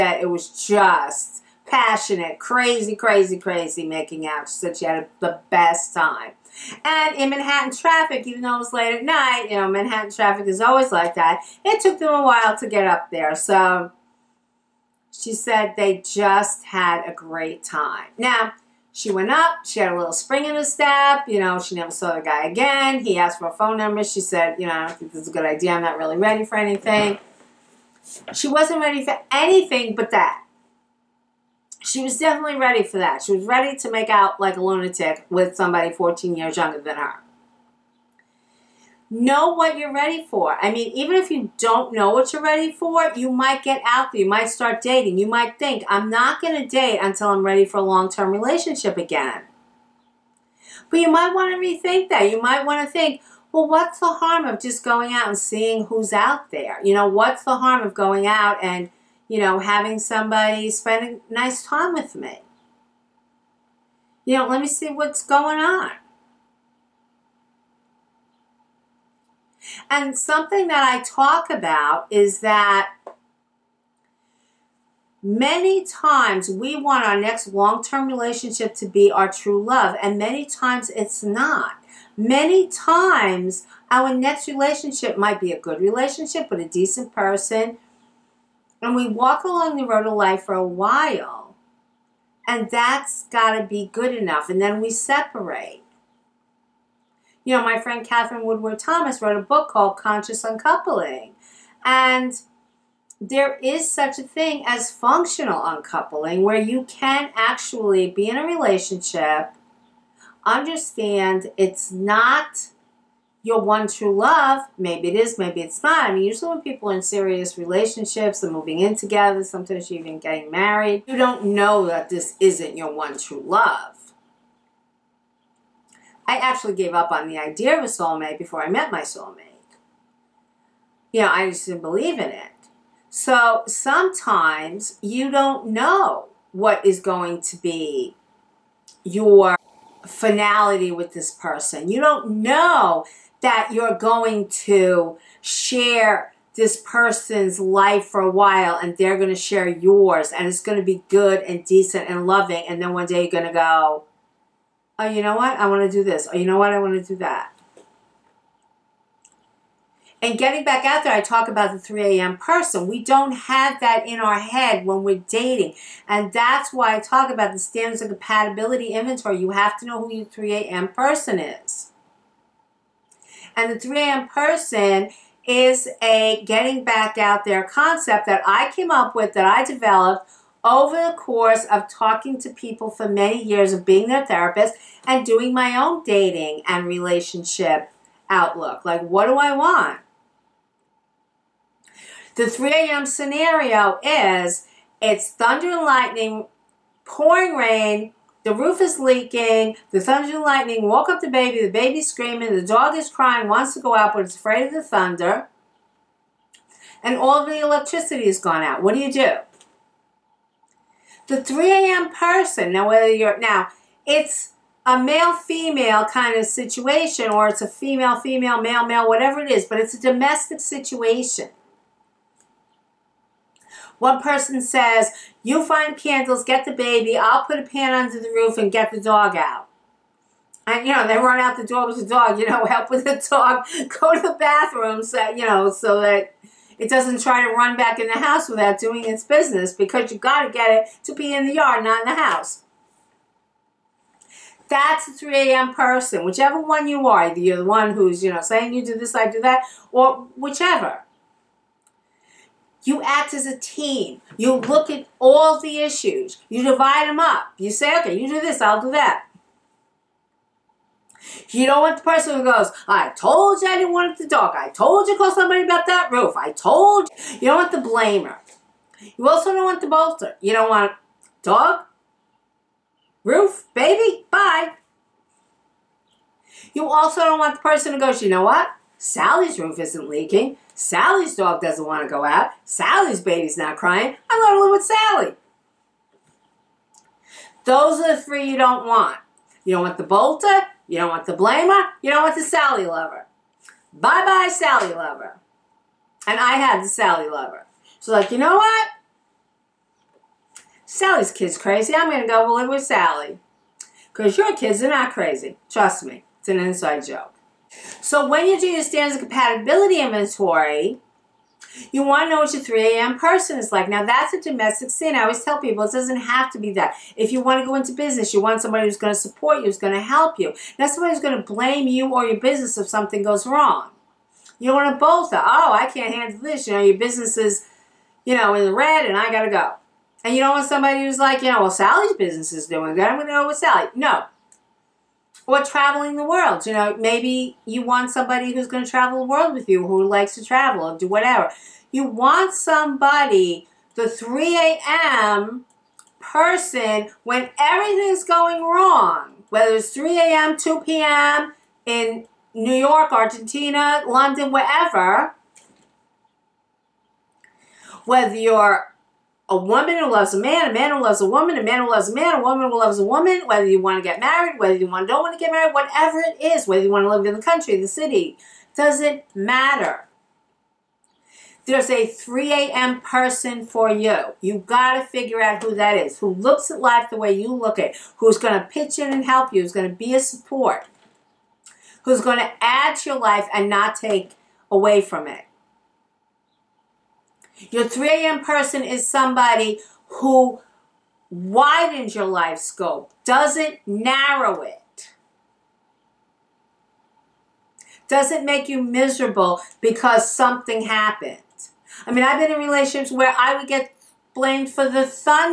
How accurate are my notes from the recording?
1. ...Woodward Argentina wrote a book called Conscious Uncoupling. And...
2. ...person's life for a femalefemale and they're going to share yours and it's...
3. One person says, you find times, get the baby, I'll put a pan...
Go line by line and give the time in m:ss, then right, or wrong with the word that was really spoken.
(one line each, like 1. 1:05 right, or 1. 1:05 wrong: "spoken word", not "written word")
1. 1:38 wrong: "Thomas", not "Argentina"
2. 2:26 wrong: "while", not "femalefemale"
3. 3:43 wrong: "candles", not "times".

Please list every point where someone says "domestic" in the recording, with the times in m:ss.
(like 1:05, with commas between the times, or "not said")
3:40, 5:14.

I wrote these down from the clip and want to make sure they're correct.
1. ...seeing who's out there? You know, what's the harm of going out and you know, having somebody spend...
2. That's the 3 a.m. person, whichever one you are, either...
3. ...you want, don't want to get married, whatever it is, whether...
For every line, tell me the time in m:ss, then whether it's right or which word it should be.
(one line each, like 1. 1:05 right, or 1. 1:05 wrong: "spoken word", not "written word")
1. 0:55 right
2. 4:04 right
3. 6:04 right.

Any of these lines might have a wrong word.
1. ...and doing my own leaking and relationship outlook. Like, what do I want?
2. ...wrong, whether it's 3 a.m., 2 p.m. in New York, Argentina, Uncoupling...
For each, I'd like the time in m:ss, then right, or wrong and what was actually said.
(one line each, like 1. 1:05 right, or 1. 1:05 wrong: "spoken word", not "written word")
1. 3:05 wrong: "dating", not "leaking"
2. 5:48 wrong: "London", not "Uncoupling".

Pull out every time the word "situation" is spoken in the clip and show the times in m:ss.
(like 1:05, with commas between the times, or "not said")
3:36, 3:40.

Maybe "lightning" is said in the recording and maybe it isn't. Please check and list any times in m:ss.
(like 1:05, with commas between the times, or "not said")
3:15, 3:20.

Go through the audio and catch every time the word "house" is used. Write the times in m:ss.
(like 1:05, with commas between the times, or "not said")
3:58, 4:02.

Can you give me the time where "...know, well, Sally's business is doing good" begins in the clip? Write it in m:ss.
5:31.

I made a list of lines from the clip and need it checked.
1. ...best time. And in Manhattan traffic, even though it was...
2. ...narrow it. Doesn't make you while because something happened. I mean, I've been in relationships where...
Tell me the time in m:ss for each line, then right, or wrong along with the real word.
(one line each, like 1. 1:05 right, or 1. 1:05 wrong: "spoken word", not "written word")
1. 0:05 right
2. 6:33 wrong: "miserable", not "while".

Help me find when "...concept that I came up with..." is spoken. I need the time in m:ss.
2:57.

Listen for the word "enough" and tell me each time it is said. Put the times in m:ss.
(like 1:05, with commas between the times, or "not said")
1:34.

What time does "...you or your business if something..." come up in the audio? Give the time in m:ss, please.
5:21.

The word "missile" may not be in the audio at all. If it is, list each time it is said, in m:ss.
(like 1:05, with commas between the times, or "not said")
not said.